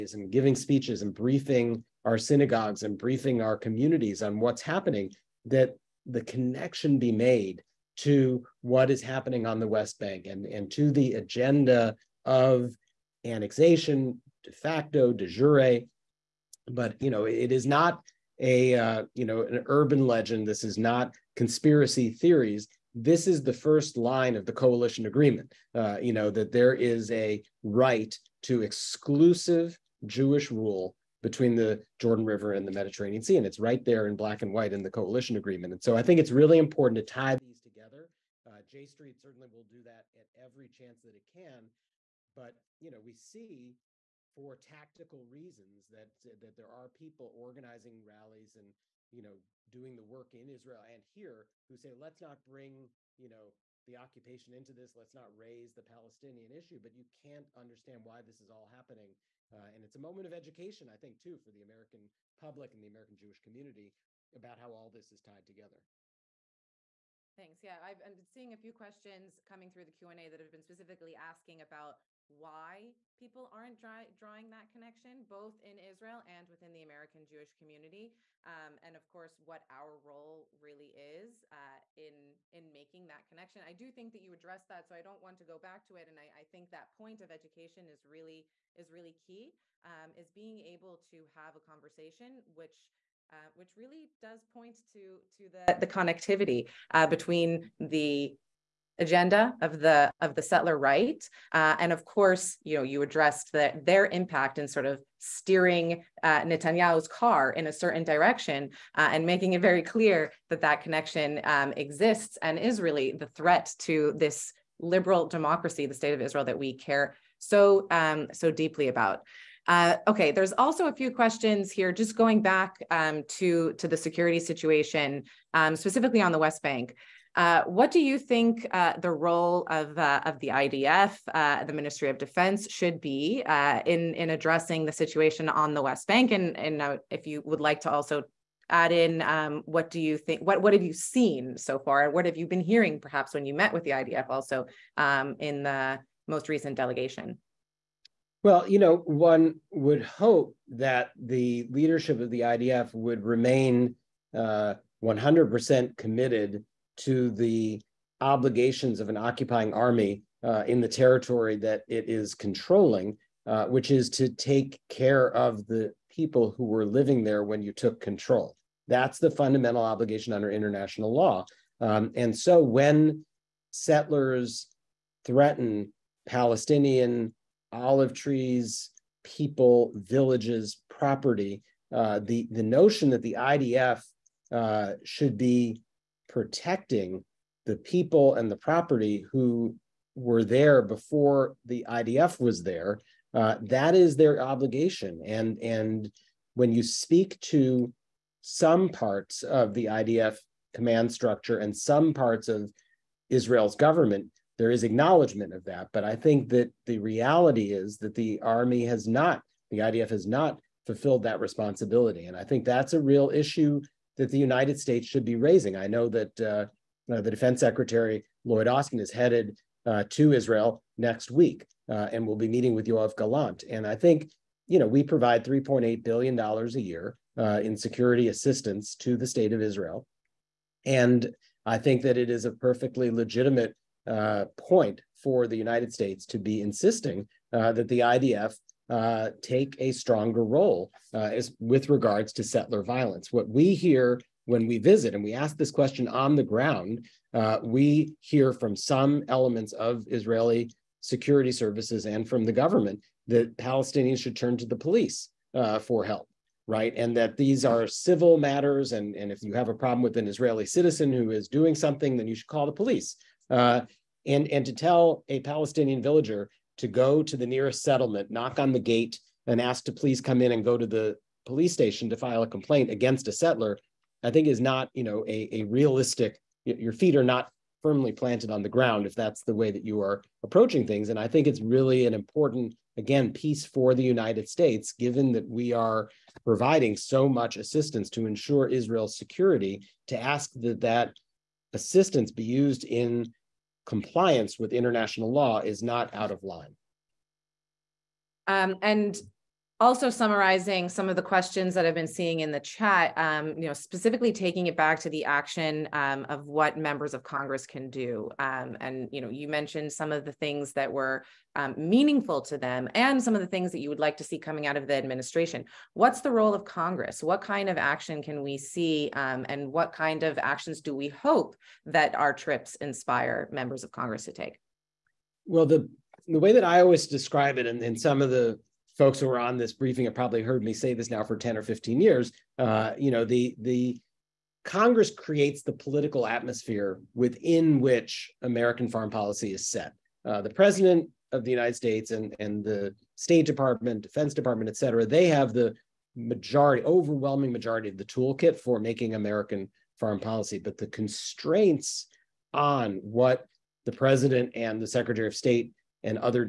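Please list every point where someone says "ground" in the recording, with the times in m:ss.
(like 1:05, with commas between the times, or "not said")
4:06, 4:38.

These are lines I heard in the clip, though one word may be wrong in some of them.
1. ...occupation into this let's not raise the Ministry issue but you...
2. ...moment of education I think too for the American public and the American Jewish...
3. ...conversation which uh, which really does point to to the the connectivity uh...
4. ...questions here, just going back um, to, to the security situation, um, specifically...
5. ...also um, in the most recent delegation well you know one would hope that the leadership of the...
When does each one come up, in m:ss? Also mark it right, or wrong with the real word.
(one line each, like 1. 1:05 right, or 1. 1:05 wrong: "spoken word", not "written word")
1. 0:53 wrong: "Palestinian", not "Ministry"
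2. 1:00 right
3. 1:31 right
4. 2:01 right
5. 2:24 right.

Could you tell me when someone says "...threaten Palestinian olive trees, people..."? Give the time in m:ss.
2:55.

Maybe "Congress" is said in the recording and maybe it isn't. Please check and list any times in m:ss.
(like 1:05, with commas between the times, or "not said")
5:07, 5:16, 5:23, 5:34.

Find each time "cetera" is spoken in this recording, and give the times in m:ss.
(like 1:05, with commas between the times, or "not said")
5:44.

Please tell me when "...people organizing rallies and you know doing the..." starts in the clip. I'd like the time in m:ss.
0:46.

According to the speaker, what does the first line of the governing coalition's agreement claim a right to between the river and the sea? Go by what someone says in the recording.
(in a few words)
exclusive Jewish rule.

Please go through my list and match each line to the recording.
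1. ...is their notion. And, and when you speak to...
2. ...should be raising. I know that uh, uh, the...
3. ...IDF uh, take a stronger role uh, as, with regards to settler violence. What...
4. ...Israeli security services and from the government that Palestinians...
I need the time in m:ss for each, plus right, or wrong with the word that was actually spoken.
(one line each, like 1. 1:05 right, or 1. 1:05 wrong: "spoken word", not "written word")
1. 3:13 wrong: "obligation", not "notion"
2. 3:35 right
3. 3:58 right
4. 4:10 right.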